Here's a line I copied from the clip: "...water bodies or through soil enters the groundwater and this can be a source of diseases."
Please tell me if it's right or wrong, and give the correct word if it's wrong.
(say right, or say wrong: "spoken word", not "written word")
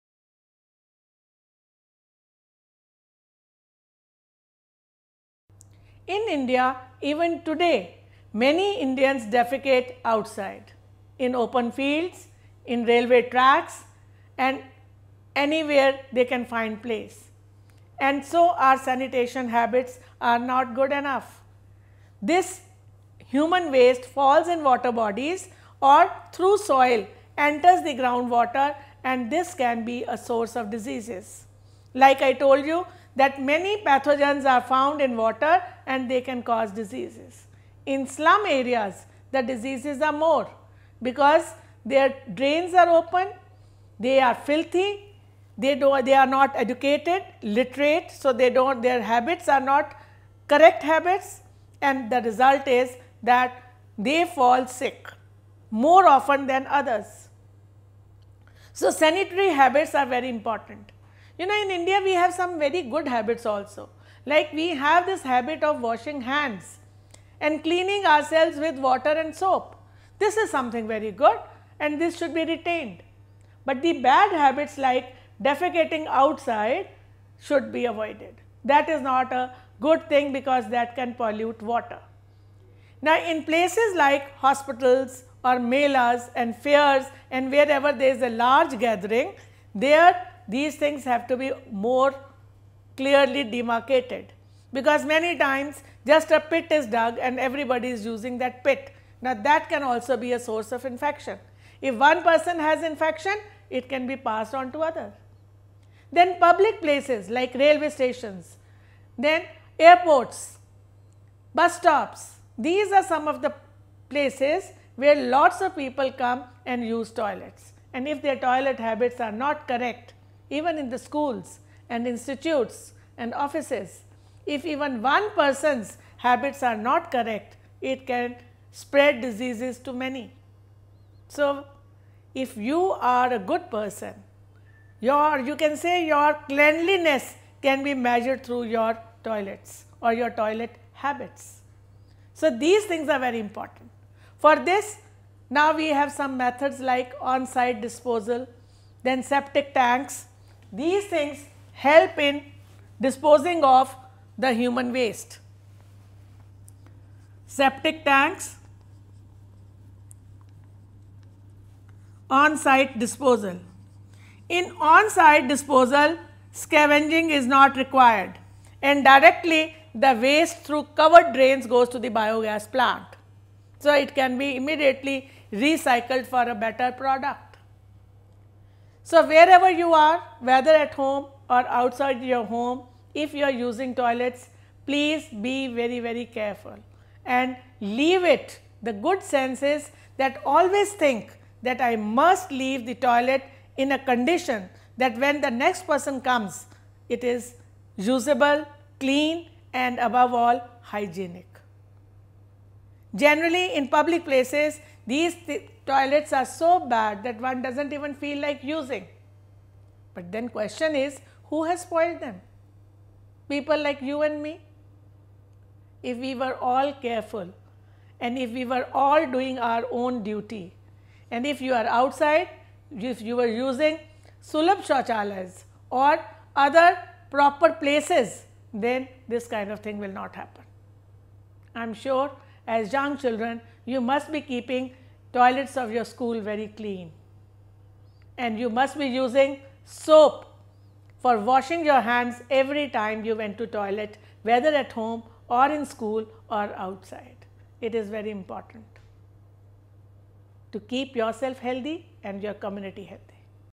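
right.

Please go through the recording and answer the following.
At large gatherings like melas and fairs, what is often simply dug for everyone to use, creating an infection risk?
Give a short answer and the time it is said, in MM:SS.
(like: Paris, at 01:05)
A pit, at 01:36.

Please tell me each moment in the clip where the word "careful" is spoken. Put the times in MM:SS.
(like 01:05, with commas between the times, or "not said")
03:06, 03:37.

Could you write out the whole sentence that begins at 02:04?
If even one person's habits are not correct, it can spread diseases to many.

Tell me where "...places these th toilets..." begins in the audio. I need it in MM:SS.
03:24.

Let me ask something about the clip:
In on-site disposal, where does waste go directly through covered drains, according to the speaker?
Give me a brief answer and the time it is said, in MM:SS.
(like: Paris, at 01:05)
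Biogas plant, at 02:52.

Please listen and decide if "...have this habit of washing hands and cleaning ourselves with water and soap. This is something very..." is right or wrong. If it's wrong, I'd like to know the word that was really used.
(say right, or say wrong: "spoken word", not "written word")
right.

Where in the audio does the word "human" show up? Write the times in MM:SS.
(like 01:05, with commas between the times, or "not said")
00:23, 02:34.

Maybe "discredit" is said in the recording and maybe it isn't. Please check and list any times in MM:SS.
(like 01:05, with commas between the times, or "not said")
not said.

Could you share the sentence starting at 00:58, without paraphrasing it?
So, sanitary habits are very important.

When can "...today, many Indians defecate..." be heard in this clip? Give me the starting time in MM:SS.
00:07.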